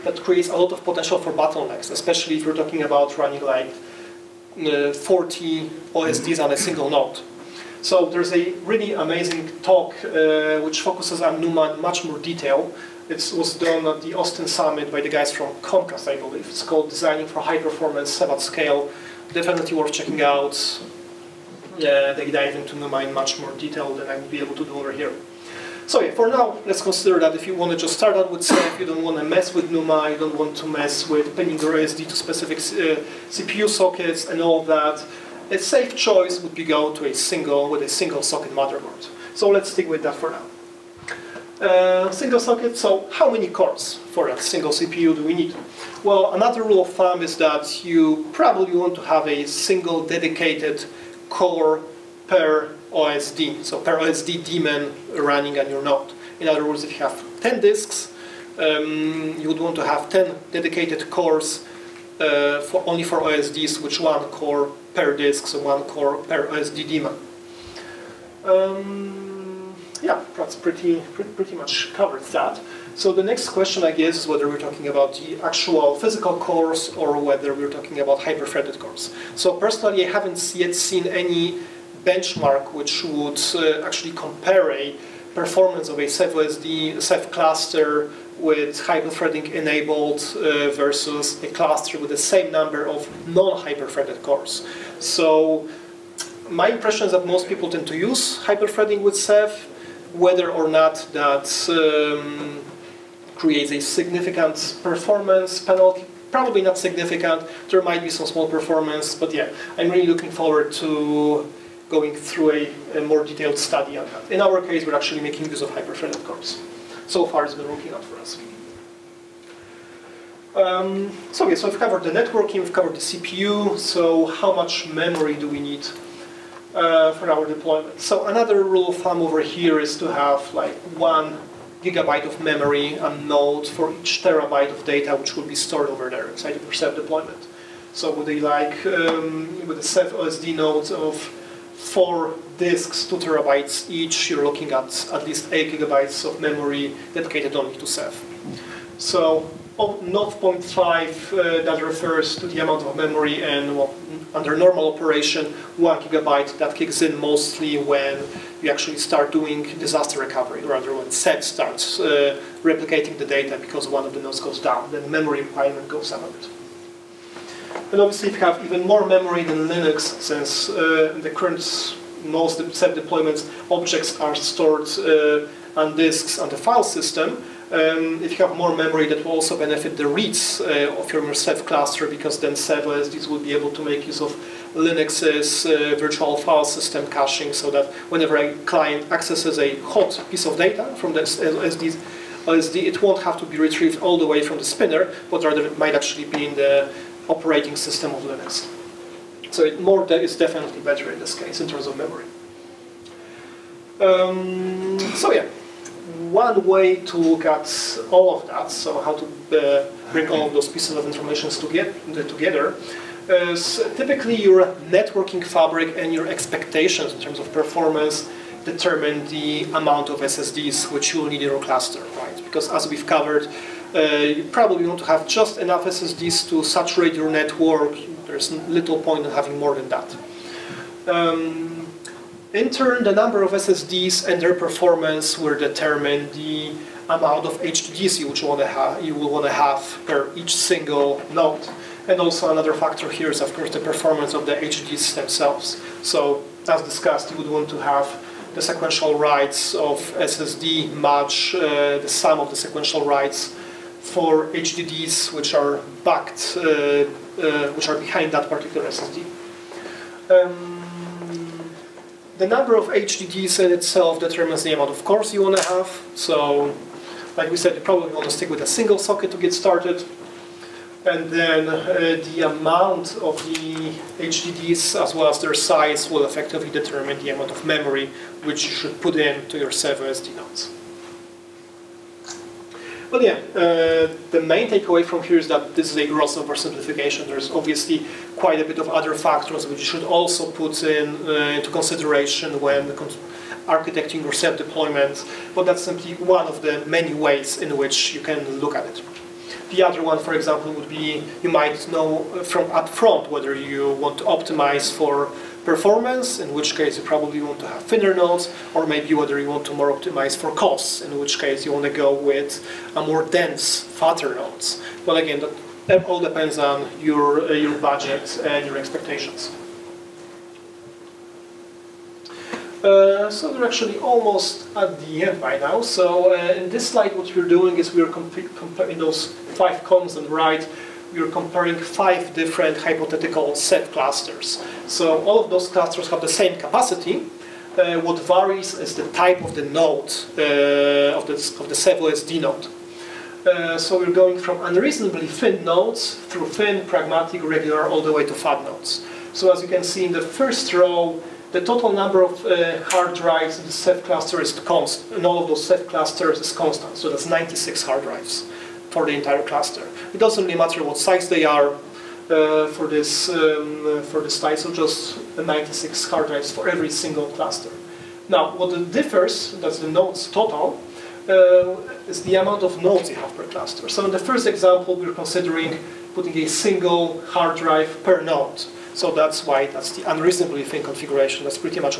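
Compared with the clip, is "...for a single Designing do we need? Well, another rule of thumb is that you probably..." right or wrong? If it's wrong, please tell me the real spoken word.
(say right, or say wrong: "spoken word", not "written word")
wrong: "CPU", not "Designing".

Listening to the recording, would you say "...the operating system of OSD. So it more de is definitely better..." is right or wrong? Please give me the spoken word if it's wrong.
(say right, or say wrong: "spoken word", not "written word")
wrong: "Linux", not "OSD".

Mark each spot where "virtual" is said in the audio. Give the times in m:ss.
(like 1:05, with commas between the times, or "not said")
3:05.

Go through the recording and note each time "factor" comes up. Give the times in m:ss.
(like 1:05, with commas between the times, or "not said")
4:02, 4:49.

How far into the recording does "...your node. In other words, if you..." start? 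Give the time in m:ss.
0:55.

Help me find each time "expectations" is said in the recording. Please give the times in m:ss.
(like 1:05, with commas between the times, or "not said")
3:36, 5:18.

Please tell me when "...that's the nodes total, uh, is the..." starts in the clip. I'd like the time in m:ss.
6:09.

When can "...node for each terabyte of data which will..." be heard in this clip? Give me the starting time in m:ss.
2:13.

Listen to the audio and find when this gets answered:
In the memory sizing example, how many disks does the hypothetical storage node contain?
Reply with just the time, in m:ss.
2:21.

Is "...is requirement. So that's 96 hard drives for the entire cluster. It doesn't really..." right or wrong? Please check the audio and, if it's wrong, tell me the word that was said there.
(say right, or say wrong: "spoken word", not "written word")
wrong: "constant", not "requirement".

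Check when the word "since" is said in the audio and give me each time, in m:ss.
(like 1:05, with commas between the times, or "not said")
2:50.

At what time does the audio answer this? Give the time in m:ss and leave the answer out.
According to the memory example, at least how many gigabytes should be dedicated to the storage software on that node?
2:25.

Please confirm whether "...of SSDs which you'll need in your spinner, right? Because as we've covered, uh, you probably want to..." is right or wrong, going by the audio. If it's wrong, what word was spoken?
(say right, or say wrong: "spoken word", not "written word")
wrong: "cluster", not "spinner".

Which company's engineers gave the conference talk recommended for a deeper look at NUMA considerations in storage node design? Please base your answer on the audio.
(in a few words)
Comcast.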